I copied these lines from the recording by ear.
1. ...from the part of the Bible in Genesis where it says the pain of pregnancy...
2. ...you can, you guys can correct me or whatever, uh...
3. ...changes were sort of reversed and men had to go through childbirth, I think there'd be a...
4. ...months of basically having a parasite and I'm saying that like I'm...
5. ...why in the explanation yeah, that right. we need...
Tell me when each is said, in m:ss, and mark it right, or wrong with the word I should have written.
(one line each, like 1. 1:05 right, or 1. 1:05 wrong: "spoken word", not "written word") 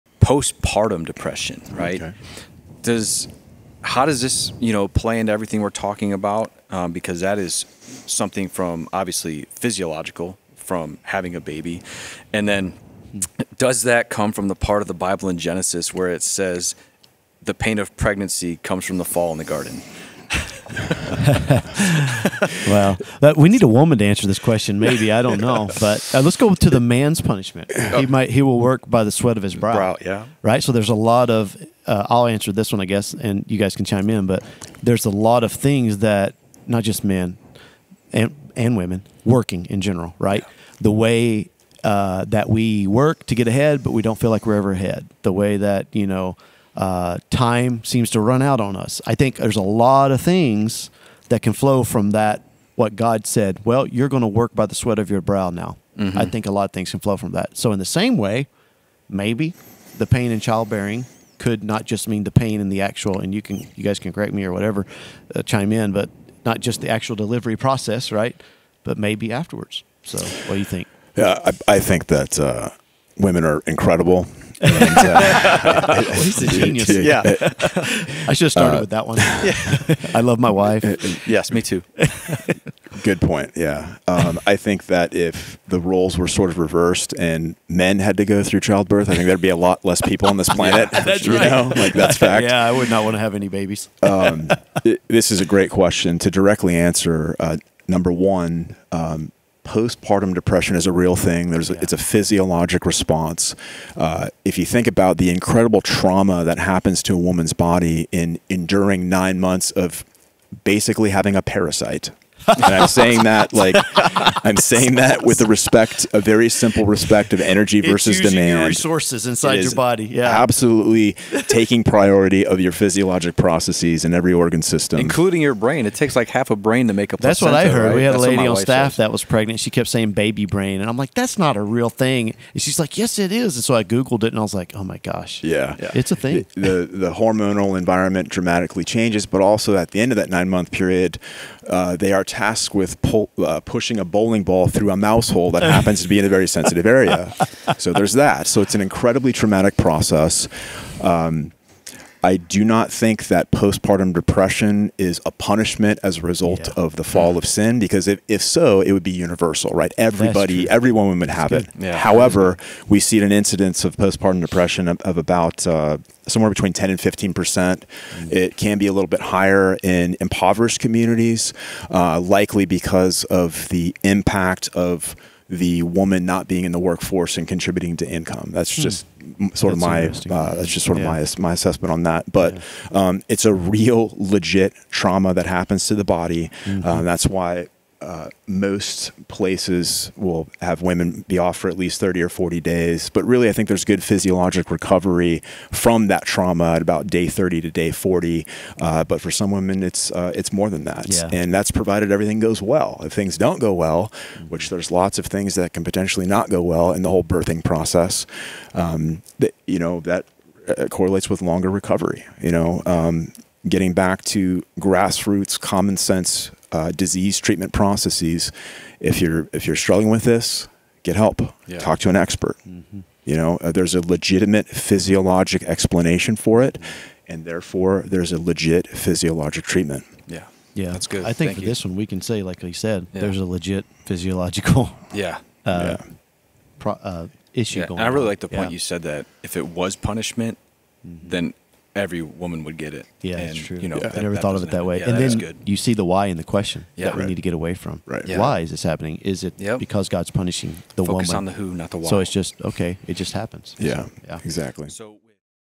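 1. 0:14 right
2. 1:03 right
3. 1:25 wrong: "roles", not "changes"
4. 1:49 right
5. 4:06 wrong: "question", not "explanation".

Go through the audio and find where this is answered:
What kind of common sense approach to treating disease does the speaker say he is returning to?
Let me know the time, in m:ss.
3:34.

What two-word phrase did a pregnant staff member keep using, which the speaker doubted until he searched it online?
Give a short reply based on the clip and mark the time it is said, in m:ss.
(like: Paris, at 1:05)
baby brain, at 2:10.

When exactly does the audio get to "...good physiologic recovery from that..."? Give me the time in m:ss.
3:13.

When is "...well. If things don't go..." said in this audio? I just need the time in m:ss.
3:22.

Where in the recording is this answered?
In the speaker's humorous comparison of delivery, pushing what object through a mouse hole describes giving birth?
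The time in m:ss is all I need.
2:24.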